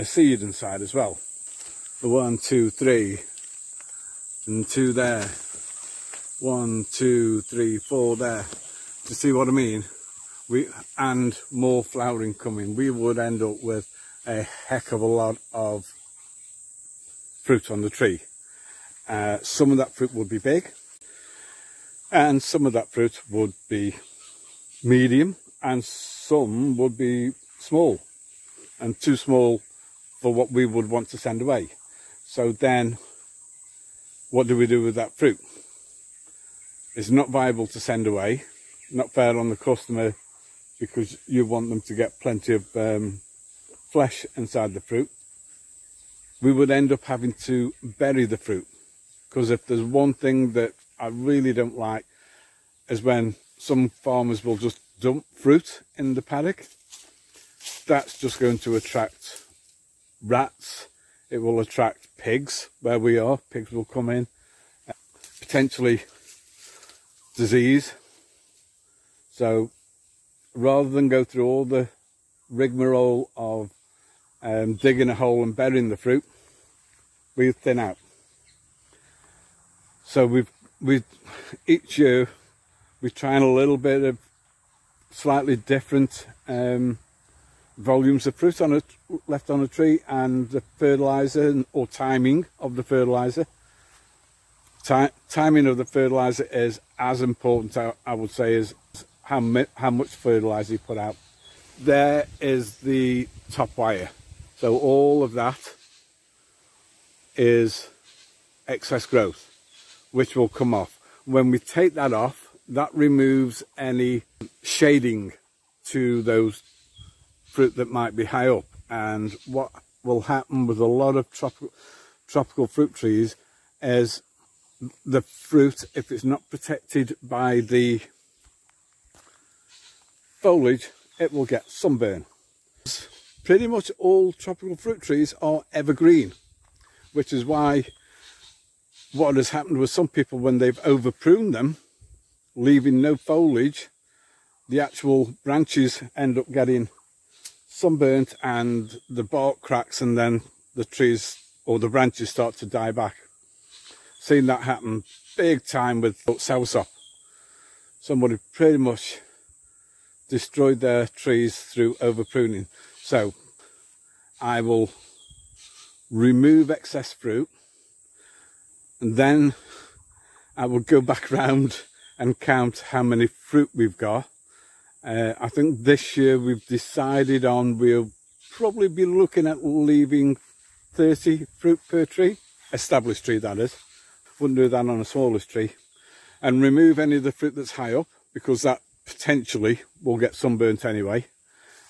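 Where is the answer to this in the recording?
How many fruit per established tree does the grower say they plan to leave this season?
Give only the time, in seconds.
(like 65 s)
180 s.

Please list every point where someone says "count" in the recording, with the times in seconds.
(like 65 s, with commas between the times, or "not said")
172 s.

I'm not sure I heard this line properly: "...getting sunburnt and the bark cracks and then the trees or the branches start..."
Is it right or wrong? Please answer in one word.
right.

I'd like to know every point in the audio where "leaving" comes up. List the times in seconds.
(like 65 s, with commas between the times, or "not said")
142 s, 179 s.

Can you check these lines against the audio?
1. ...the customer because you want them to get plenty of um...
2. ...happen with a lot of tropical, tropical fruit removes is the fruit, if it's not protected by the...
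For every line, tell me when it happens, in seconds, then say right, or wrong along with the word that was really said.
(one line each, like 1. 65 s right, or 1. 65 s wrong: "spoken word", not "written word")
1. 39 s right
2. 120 s wrong: "trees", not "removes".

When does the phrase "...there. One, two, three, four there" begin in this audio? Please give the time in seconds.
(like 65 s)
4 s.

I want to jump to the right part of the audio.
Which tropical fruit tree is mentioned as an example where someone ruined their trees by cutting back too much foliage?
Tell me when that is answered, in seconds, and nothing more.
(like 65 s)
156 s.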